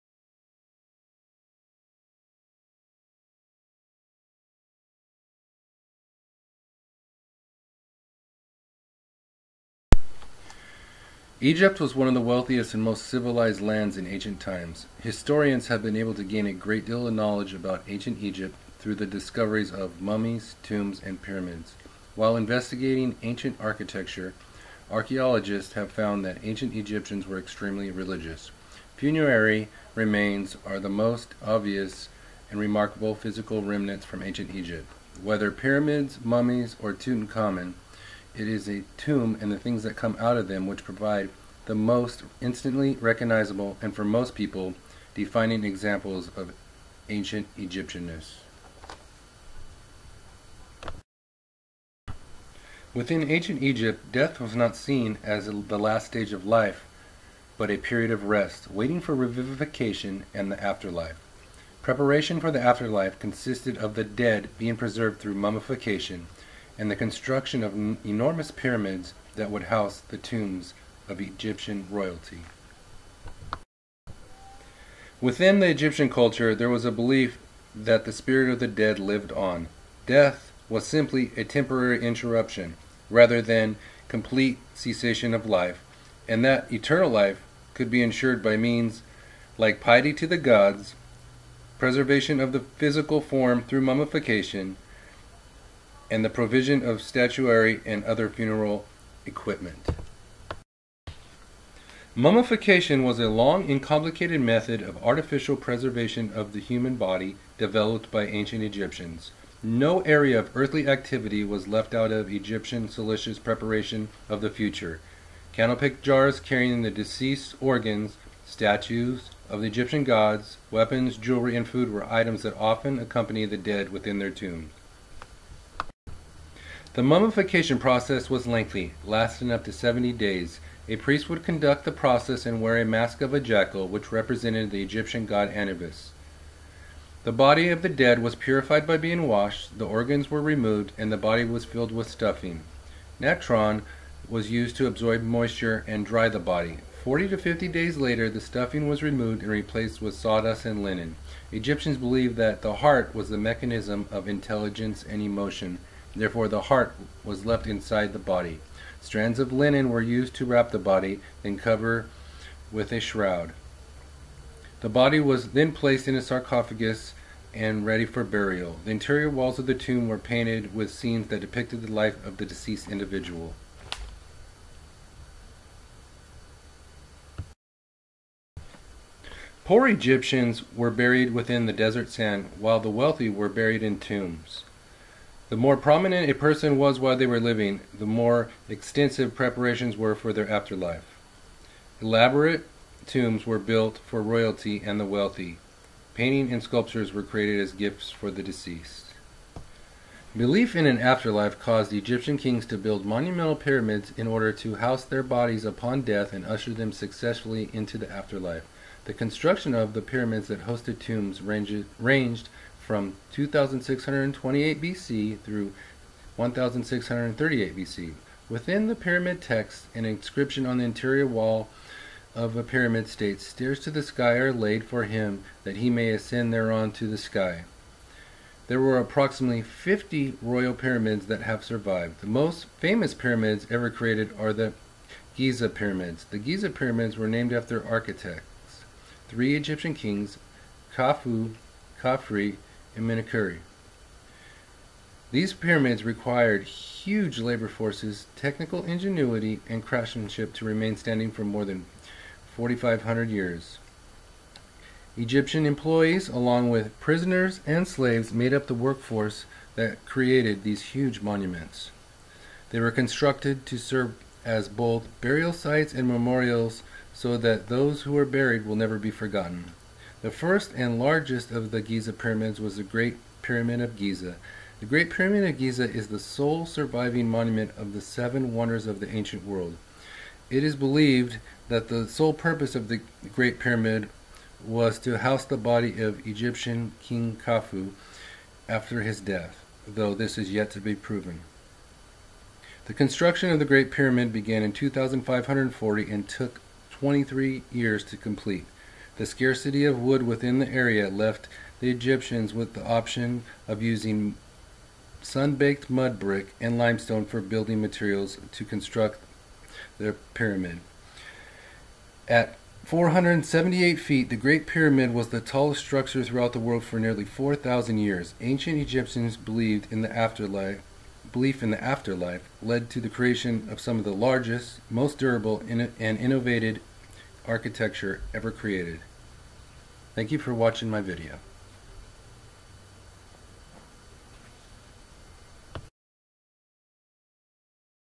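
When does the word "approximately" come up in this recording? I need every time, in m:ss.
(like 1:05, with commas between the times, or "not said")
3:48.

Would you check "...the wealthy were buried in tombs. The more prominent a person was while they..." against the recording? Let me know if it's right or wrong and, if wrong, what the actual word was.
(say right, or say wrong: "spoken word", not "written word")
right.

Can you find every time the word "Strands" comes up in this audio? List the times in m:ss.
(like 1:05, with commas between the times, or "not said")
2:39.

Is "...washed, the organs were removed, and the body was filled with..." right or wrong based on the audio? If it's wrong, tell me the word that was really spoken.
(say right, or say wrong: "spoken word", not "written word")
right.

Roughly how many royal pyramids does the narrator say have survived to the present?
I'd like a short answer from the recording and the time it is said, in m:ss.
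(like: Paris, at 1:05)
50, at 3:49.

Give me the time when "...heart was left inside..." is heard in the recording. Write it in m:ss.
2:36.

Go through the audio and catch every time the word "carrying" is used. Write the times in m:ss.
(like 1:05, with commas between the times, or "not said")
1:56.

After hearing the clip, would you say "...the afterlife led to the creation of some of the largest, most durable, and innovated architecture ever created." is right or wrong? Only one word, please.
right.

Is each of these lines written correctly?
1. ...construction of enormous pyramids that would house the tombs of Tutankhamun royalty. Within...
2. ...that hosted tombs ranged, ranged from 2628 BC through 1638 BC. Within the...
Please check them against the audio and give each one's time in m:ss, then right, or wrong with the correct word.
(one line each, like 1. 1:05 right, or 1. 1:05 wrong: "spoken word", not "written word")
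1. 1:06 wrong: "Egyptian", not "Tutankhamun"
2. 3:30 right.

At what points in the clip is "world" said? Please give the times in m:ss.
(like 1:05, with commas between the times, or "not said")
4:39, 5:16.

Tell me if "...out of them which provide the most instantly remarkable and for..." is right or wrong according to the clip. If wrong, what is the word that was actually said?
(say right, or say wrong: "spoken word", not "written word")
wrong: "recognizable", not "remarkable".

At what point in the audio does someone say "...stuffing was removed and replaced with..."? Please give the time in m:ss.
2:28.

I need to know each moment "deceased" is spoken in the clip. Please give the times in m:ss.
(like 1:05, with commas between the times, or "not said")
1:56, 2:52, 3:18.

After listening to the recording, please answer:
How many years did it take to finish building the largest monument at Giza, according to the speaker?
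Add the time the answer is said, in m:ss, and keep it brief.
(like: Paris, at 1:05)
23 years, at 4:56.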